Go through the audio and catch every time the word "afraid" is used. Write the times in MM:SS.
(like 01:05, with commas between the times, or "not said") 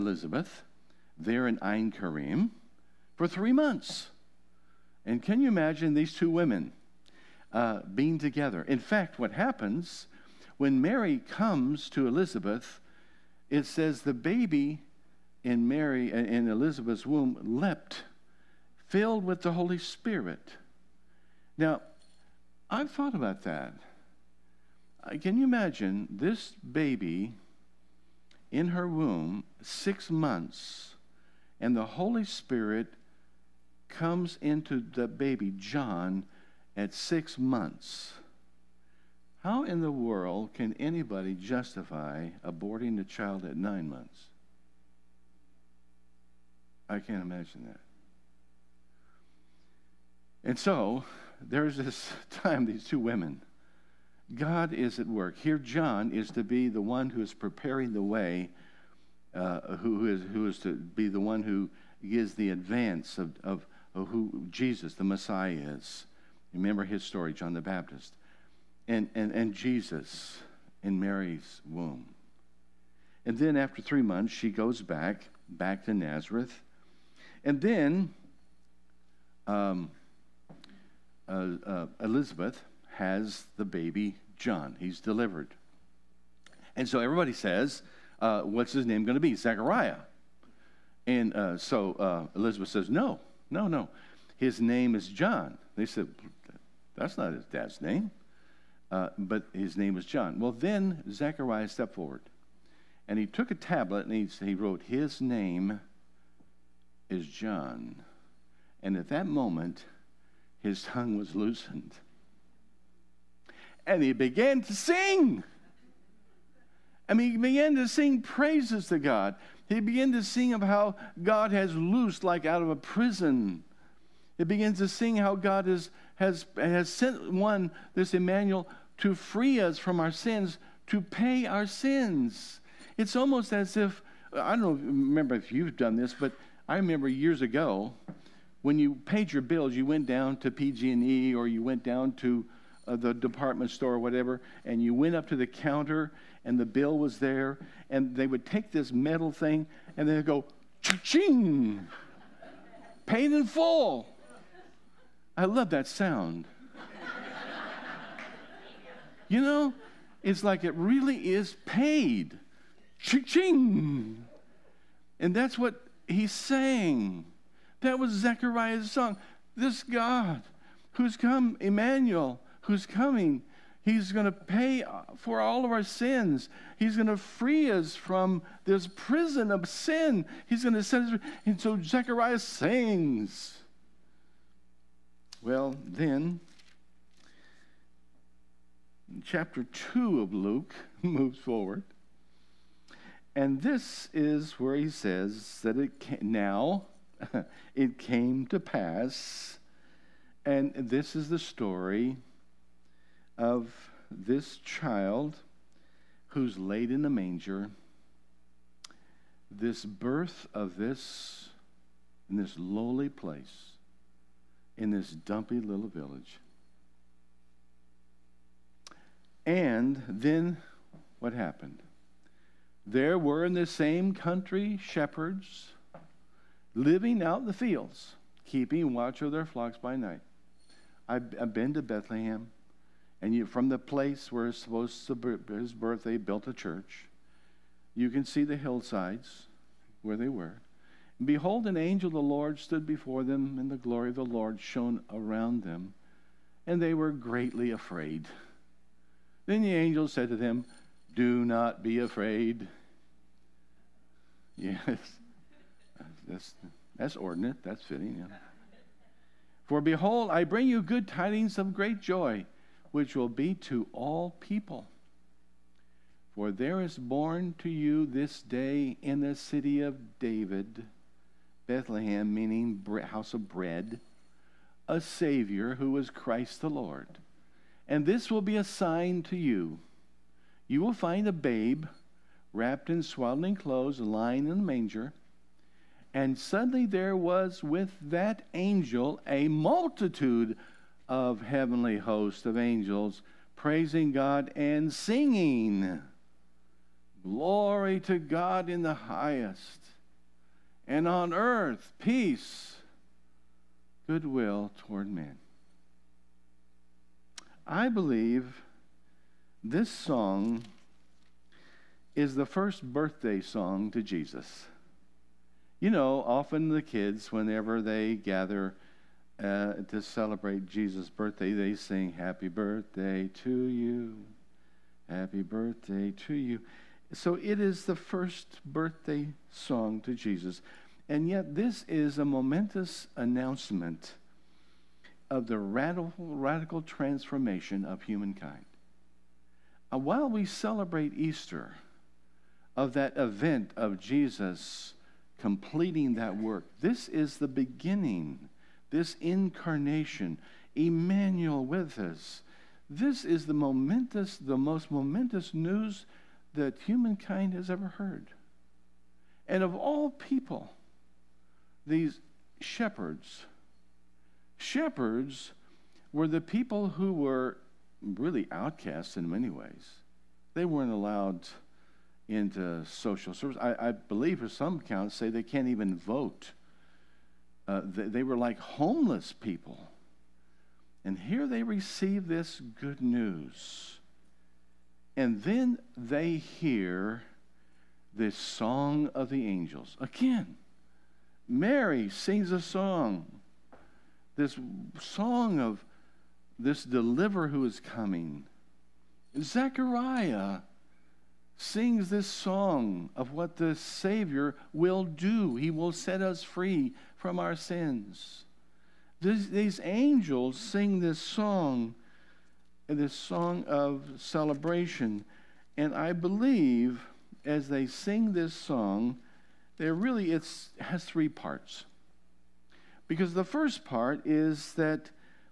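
04:07, 04:11.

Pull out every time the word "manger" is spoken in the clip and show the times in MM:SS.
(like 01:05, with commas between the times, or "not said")
03:27, 04:44.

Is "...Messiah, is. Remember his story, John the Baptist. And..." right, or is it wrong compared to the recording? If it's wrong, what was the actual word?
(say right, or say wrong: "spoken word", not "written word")
right.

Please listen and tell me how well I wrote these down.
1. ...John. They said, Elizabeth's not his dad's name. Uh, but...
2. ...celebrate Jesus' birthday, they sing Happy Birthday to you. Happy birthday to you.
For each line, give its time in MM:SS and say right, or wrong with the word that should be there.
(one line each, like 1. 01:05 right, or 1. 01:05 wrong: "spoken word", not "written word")
1. 01:35 wrong: "That", not "Elizabeth"
2. 05:20 right.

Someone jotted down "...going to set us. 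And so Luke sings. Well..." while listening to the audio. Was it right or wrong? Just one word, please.
wrong.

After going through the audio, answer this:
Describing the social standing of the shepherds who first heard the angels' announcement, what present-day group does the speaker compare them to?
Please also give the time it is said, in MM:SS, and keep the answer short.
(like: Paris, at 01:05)
Homeless people, at 06:18.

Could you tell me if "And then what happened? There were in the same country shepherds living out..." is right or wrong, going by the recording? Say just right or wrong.
right.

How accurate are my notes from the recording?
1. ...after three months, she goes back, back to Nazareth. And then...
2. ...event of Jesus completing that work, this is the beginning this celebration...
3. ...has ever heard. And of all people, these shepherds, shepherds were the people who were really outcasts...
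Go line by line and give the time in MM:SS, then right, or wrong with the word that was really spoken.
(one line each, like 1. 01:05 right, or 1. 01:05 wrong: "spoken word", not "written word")
1. 01:13 right
2. 05:43 wrong: "incarnation", not "celebration"
3. 05:57 right.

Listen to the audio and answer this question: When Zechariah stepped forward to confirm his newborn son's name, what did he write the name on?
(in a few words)
A tablet.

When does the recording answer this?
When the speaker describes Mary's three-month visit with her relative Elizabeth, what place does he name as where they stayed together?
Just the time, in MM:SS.
00:01.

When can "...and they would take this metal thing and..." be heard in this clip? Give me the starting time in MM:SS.
02:27.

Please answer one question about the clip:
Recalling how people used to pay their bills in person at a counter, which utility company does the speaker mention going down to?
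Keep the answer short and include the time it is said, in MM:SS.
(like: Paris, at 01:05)
PG&E, at 02:20.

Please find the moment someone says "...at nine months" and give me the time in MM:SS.
00:43.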